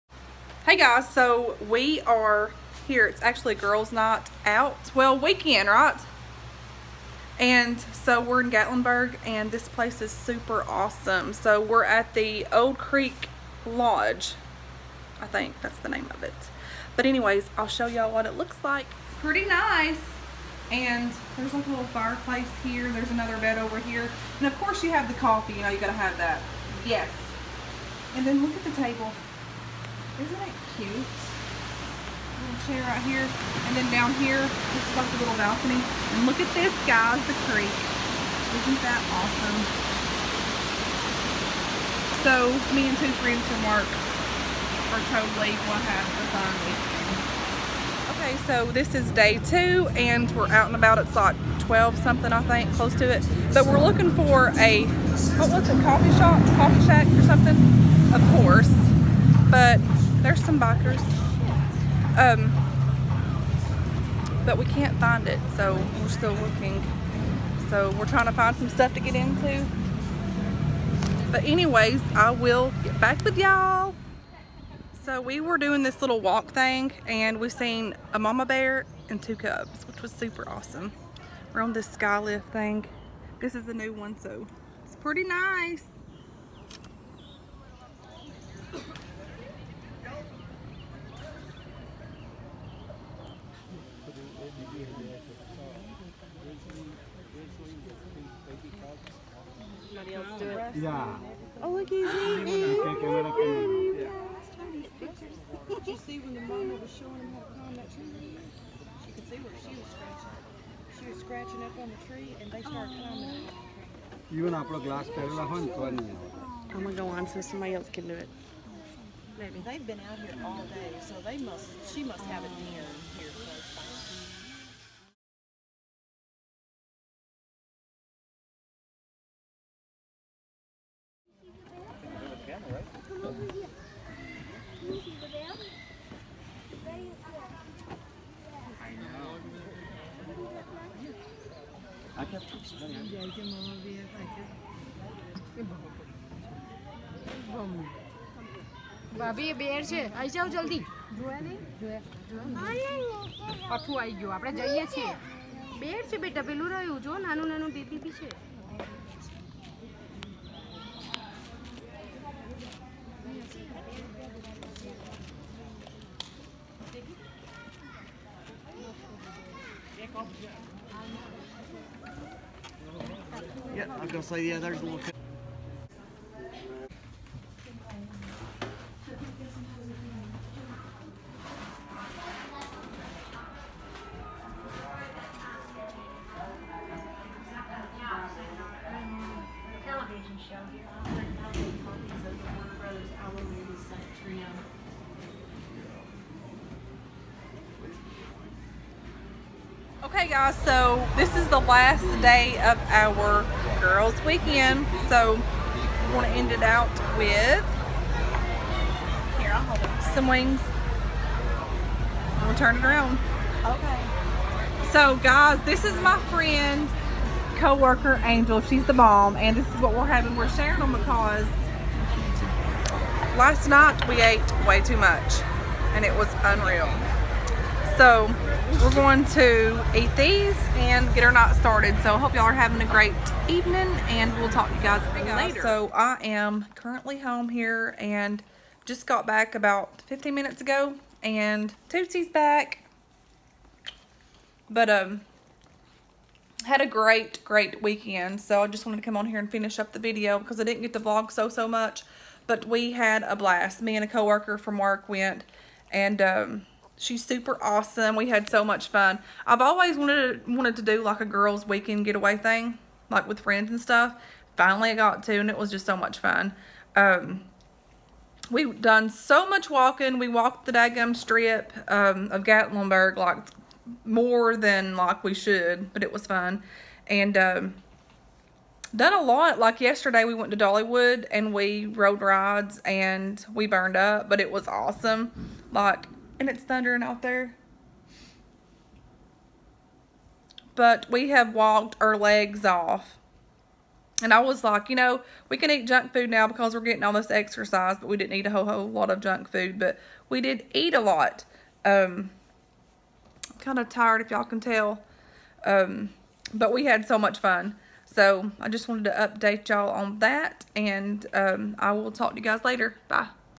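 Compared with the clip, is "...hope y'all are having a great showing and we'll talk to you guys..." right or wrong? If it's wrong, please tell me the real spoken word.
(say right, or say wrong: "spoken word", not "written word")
wrong: "evening", not "showing".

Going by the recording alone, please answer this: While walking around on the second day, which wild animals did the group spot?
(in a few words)
a mama bear and two cubs.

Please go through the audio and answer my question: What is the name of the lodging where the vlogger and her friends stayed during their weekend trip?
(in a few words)
Old Creek Lodge.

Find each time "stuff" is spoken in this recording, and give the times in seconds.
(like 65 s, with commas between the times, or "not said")
68 s, 263 s.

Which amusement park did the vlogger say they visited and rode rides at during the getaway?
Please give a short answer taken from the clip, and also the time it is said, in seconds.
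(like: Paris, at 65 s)
Dollywood, at 280 s.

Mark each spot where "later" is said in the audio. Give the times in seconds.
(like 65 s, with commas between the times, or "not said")
235 s, 312 s.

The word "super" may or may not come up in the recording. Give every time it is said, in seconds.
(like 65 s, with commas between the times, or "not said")
10 s, 80 s, 257 s.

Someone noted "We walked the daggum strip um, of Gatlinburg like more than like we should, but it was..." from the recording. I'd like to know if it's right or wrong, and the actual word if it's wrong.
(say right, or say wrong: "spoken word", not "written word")
right.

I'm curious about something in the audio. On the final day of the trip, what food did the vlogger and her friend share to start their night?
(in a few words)
Wings.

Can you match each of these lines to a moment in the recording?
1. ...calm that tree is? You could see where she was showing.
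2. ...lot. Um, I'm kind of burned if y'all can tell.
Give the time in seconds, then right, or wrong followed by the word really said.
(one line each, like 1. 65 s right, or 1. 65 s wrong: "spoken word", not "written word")
1. 107 s wrong: "scratching", not "showing"
2. 300 s wrong: "tired", not "burned".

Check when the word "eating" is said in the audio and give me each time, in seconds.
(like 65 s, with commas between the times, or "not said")
102 s.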